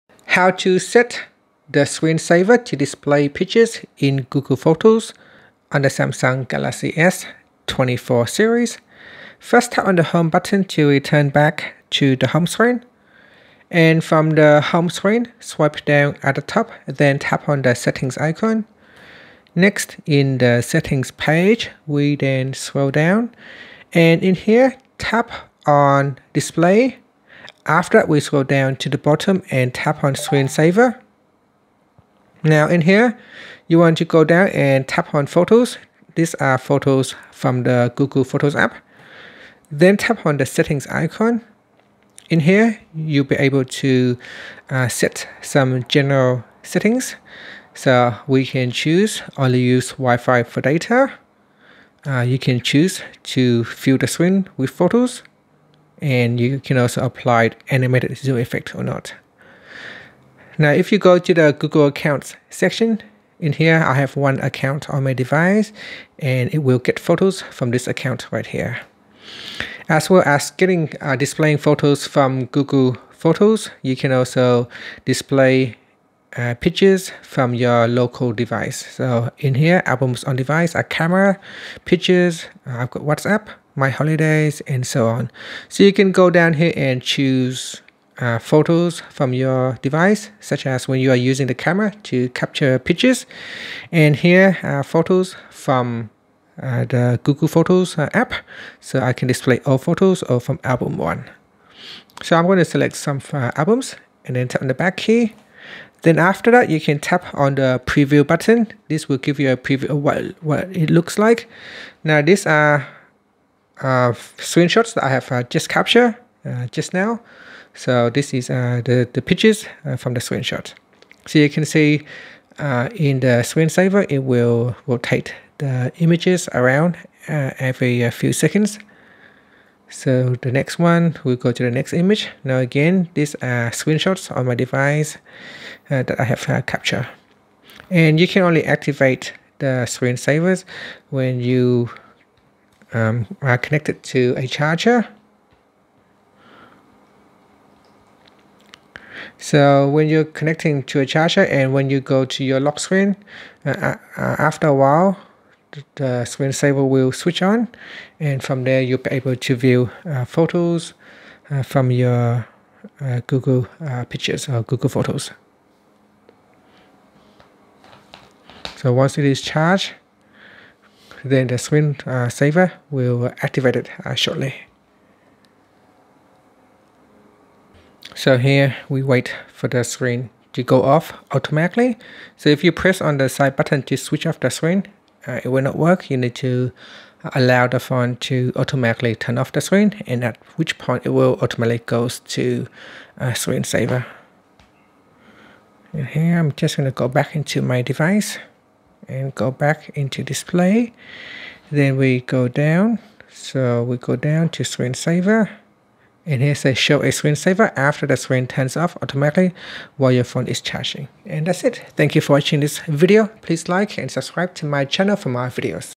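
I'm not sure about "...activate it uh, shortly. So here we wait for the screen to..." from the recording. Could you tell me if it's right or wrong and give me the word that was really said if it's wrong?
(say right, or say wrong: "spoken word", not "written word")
right.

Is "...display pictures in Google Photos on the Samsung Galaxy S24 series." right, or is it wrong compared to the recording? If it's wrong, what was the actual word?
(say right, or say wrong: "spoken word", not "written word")
right.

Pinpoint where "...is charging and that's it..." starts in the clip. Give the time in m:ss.
3:30.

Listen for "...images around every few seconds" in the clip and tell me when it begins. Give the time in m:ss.
2:05.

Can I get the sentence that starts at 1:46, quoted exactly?
Then after that, you can tap on the preview button.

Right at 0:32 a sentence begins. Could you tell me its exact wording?
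Now in here, you want to go down and tap on photos.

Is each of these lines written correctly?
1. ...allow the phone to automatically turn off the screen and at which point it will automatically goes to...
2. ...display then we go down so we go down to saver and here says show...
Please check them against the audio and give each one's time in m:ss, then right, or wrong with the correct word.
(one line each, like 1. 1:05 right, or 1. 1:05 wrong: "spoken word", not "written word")
1. 3:07 right
2. 3:20 wrong: "screensaver", not "saver".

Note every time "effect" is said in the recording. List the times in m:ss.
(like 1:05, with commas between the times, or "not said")
0:58.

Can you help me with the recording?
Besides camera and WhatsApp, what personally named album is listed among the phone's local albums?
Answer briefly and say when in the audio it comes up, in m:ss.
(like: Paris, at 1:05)
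my holidays, at 1:23.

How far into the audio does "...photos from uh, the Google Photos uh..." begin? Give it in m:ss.
1:34.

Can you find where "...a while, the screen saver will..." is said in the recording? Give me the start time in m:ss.
2:34.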